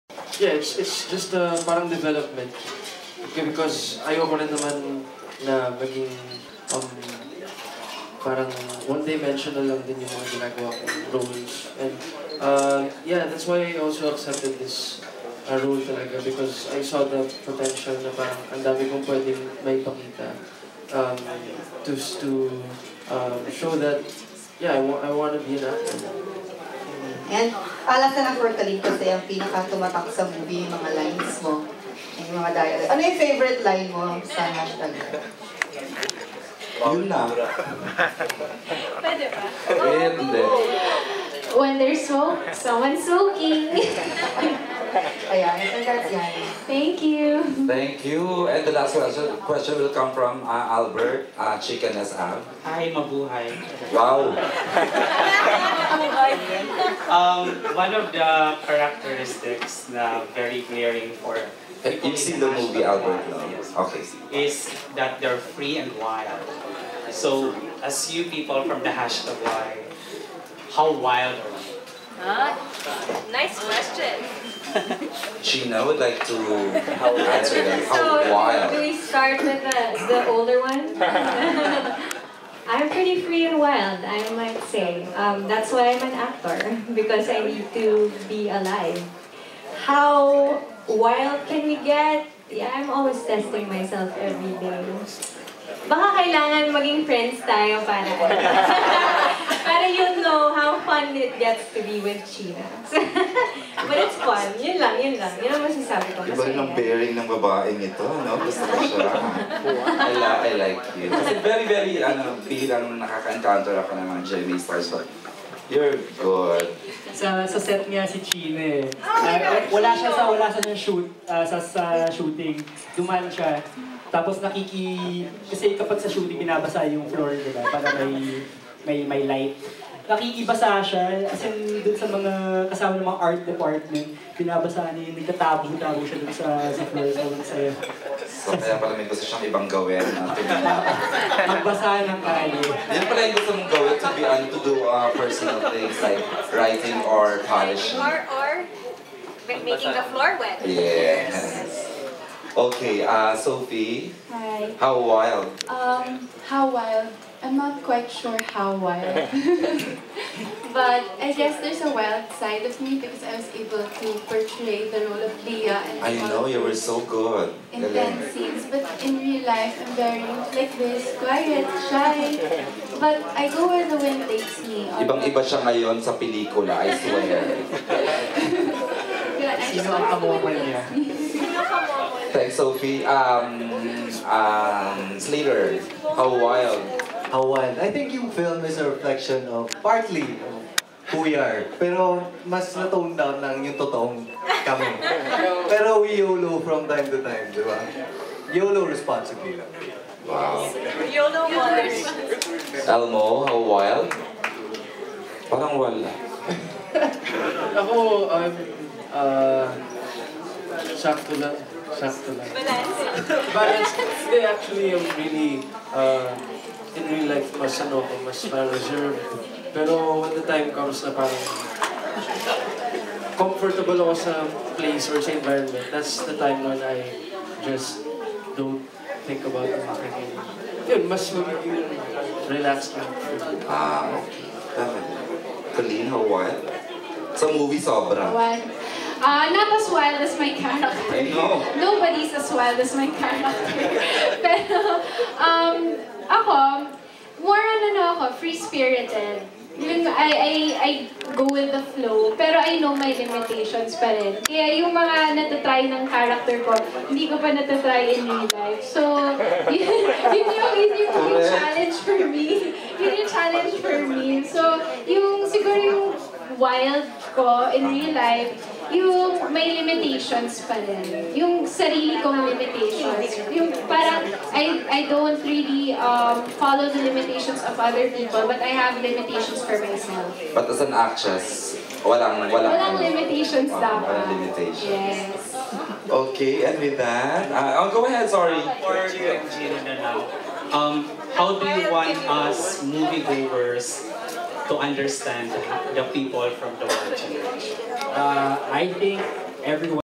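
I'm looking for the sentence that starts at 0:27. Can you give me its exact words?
And Alas na nag-workalik kasi ang pinaka-tumatak sa movie yung mga lines mo.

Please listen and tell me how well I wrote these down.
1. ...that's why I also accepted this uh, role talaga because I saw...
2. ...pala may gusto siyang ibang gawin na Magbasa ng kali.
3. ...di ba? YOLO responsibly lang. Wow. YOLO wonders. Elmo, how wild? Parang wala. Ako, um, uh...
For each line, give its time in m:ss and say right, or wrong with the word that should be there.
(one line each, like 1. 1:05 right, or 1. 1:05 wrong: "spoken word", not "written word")
1. 0:13 right
2. 2:18 right
3. 3:17 right.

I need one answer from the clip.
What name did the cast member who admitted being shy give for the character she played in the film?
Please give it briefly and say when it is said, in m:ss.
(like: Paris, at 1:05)
Leah, at 2:45.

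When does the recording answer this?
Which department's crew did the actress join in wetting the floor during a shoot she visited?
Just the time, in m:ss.
2:13.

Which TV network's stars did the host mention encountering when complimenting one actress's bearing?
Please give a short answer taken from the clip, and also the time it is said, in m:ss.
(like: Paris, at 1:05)
GMA, at 1:54.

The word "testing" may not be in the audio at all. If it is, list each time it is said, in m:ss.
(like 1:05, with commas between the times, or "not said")
1:33.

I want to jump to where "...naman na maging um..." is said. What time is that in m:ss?
0:04.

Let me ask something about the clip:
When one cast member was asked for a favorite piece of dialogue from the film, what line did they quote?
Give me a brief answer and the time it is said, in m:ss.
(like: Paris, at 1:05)
When there's smoke, someone's smoking, at 0:41.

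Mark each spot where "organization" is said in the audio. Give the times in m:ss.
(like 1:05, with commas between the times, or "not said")
not said.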